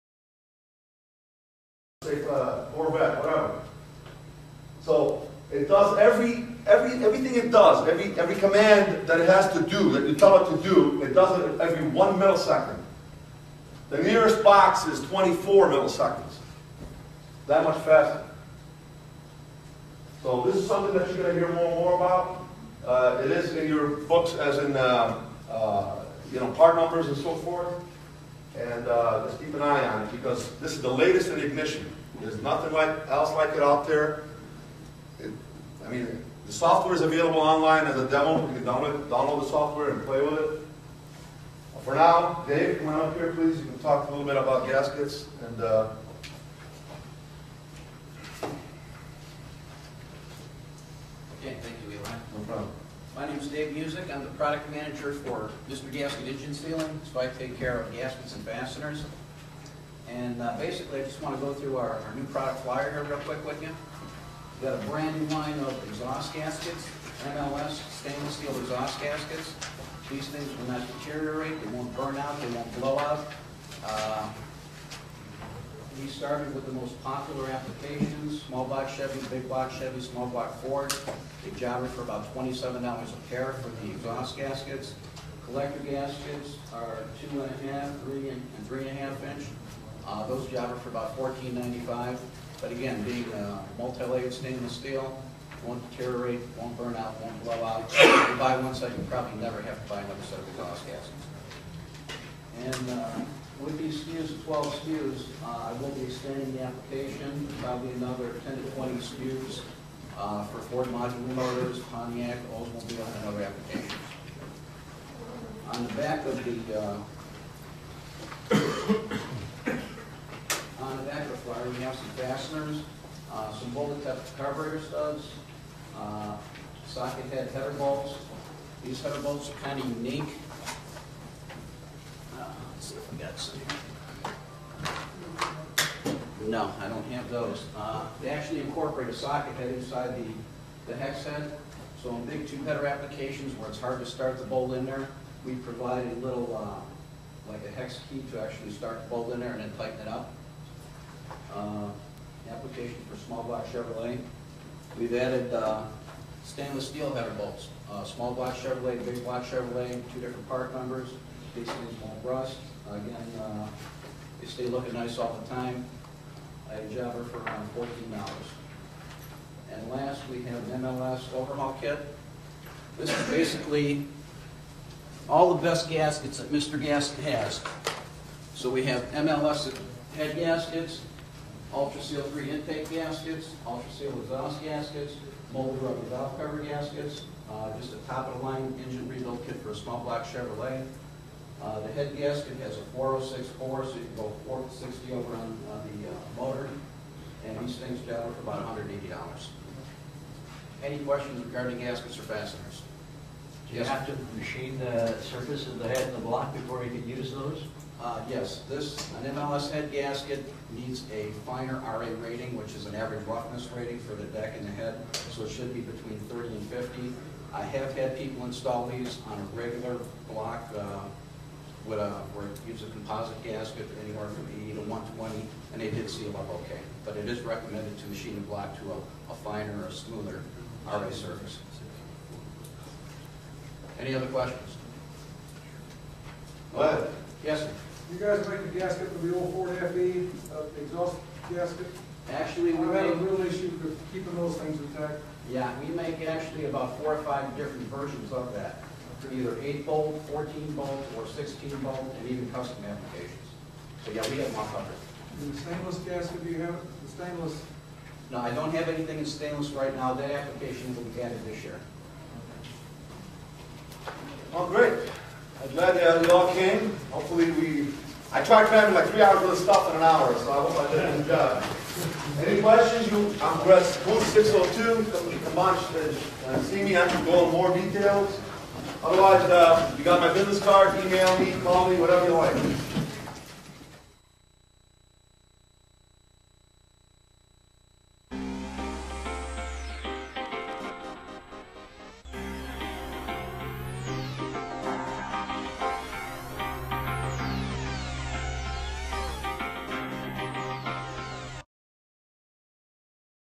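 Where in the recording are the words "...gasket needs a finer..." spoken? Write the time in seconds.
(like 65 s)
209 s.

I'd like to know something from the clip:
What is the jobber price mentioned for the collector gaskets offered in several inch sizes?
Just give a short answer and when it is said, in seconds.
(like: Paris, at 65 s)
$14.95, at 91 s.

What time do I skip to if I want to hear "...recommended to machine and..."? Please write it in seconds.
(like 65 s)
227 s.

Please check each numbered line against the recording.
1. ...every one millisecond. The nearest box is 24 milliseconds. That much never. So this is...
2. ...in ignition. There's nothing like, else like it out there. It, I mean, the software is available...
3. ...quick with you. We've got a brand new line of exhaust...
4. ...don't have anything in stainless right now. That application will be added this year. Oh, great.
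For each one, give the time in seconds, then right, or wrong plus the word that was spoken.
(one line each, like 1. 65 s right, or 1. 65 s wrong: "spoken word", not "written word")
1. 11 s wrong: "faster", not "never"
2. 31 s right
3. 63 s right
4. 258 s right.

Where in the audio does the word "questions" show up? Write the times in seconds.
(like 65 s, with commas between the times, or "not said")
200 s, 234 s, 272 s.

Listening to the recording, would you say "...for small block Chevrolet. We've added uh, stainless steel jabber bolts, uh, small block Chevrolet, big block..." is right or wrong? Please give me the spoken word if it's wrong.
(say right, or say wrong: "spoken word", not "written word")
wrong: "header", not "jabber".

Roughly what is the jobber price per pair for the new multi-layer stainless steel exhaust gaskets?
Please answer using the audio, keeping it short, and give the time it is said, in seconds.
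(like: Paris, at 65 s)
$27, at 82 s.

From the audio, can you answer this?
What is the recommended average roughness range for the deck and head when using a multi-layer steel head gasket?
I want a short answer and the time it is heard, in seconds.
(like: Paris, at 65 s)
30 to 50, at 215 s.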